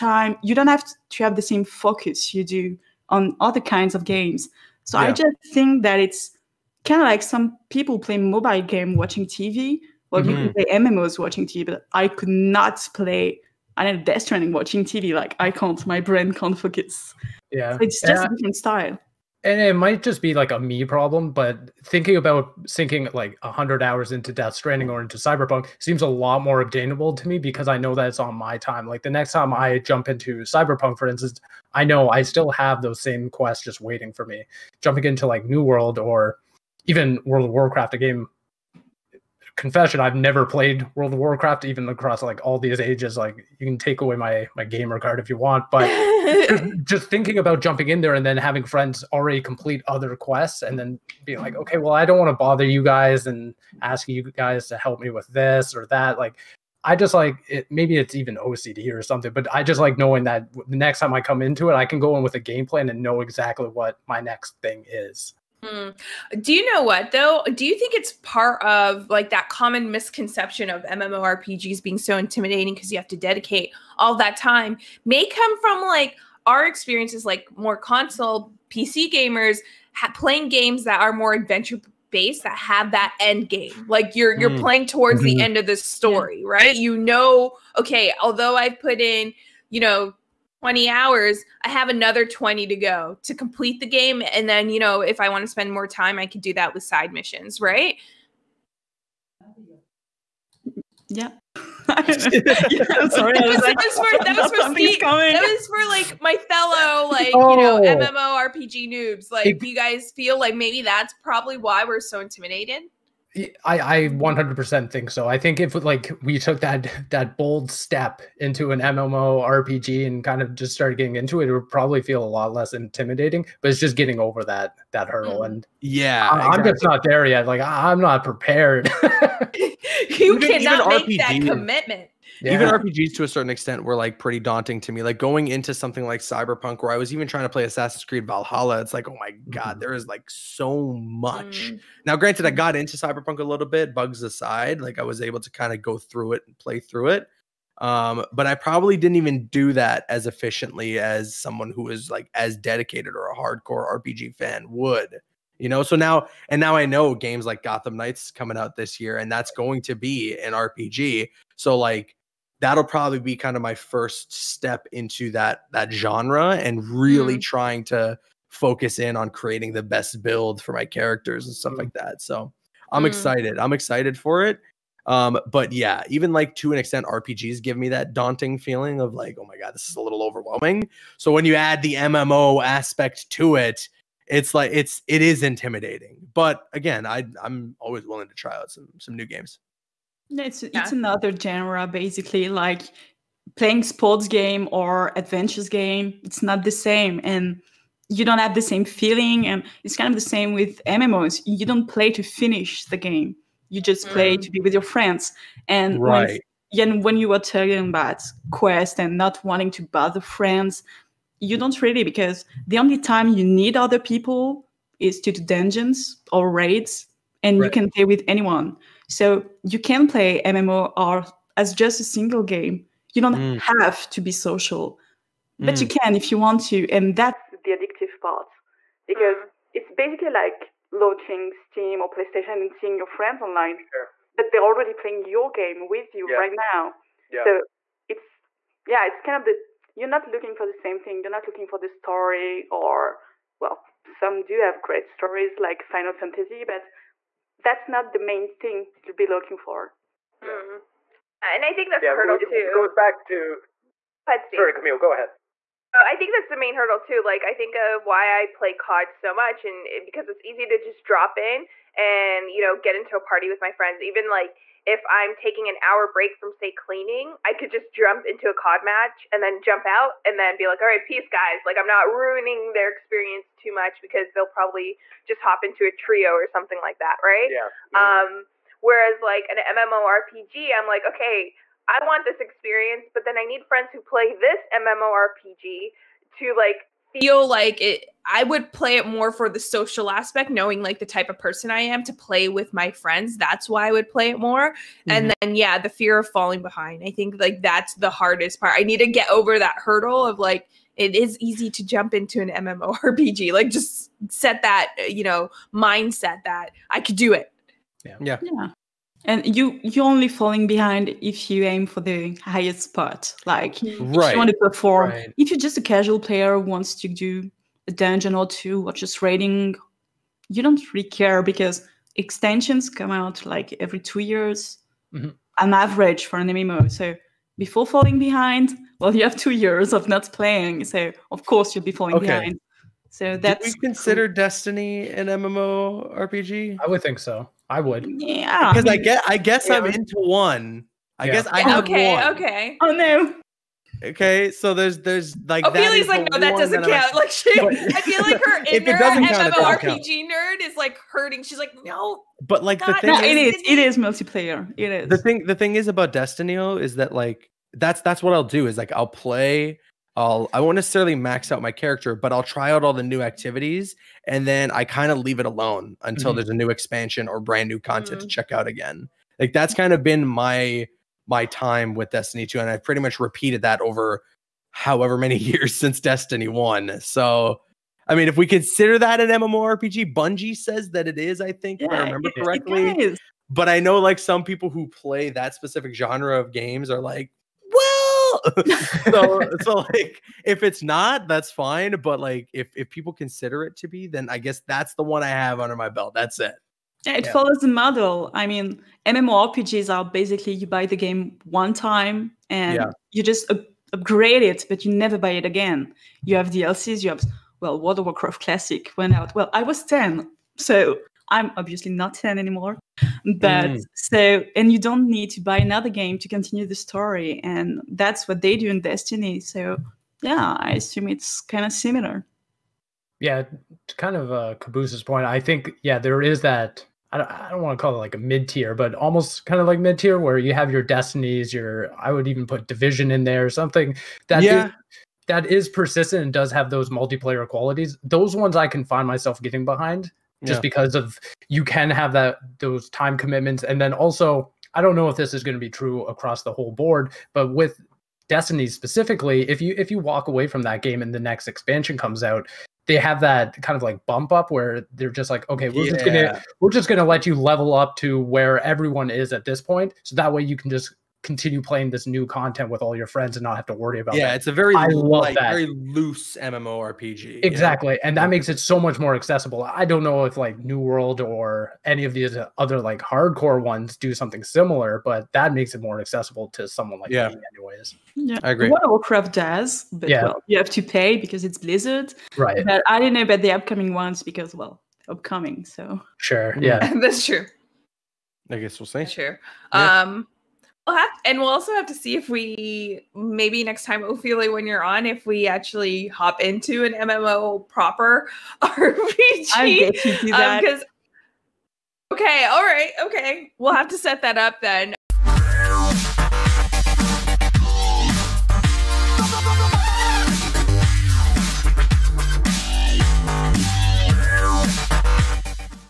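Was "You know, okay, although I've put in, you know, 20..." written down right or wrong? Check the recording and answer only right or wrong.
right.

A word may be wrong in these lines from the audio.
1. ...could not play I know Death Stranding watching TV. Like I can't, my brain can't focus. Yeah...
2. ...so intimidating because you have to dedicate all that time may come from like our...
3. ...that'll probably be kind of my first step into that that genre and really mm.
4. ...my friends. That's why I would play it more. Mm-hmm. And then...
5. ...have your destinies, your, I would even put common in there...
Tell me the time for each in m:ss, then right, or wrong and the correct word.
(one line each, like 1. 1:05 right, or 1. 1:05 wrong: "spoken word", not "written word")
1. 0:12 right
2. 1:11 right
3. 2:42 right
4. 4:52 right
5. 7:10 wrong: "division", not "common".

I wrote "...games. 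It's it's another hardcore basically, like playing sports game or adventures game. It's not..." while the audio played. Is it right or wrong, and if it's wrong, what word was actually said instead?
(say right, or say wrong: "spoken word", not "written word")
wrong: "genre", not "hardcore".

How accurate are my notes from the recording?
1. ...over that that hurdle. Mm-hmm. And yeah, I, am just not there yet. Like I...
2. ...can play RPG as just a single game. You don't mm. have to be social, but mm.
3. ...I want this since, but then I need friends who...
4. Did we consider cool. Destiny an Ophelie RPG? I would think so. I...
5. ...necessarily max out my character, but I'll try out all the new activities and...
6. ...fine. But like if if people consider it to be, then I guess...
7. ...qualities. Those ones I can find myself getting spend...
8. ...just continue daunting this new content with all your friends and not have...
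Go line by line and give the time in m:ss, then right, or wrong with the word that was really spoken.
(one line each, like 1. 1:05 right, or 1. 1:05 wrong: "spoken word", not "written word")
1. 2:04 right
2. 3:39 wrong: "MMOR", not "RPG"
3. 4:41 wrong: "experience", not "since"
4. 5:33 wrong: "MMO", not "Ophelie"
5. 6:00 right
6. 6:31 right
7. 7:17 wrong: "behind", not "spend"
8. 7:40 wrong: "playing", not "daunting".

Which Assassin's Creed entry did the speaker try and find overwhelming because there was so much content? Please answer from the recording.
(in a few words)
Valhalla.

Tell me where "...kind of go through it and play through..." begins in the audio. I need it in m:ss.
2:25.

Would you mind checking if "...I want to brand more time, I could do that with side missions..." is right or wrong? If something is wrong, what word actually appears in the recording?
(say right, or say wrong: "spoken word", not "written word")
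wrong: "spend", not "brand".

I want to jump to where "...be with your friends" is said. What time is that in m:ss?
3:24.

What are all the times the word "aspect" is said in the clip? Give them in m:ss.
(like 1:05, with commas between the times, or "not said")
3:02, 4:50.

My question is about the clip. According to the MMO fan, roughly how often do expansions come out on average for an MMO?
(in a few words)
every 2 years.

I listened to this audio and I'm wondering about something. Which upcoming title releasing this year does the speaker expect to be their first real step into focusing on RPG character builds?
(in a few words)
Gotham Knights.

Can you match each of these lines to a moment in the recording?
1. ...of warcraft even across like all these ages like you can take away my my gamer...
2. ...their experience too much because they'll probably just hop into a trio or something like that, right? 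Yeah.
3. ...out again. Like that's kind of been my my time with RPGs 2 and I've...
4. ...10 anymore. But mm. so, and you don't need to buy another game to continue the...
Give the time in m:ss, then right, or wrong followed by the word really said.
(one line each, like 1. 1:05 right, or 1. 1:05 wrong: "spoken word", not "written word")
1. 0:41 right
2. 4:32 right
3. 6:08 wrong: "Destiny", not "RPGs"
4. 6:52 right.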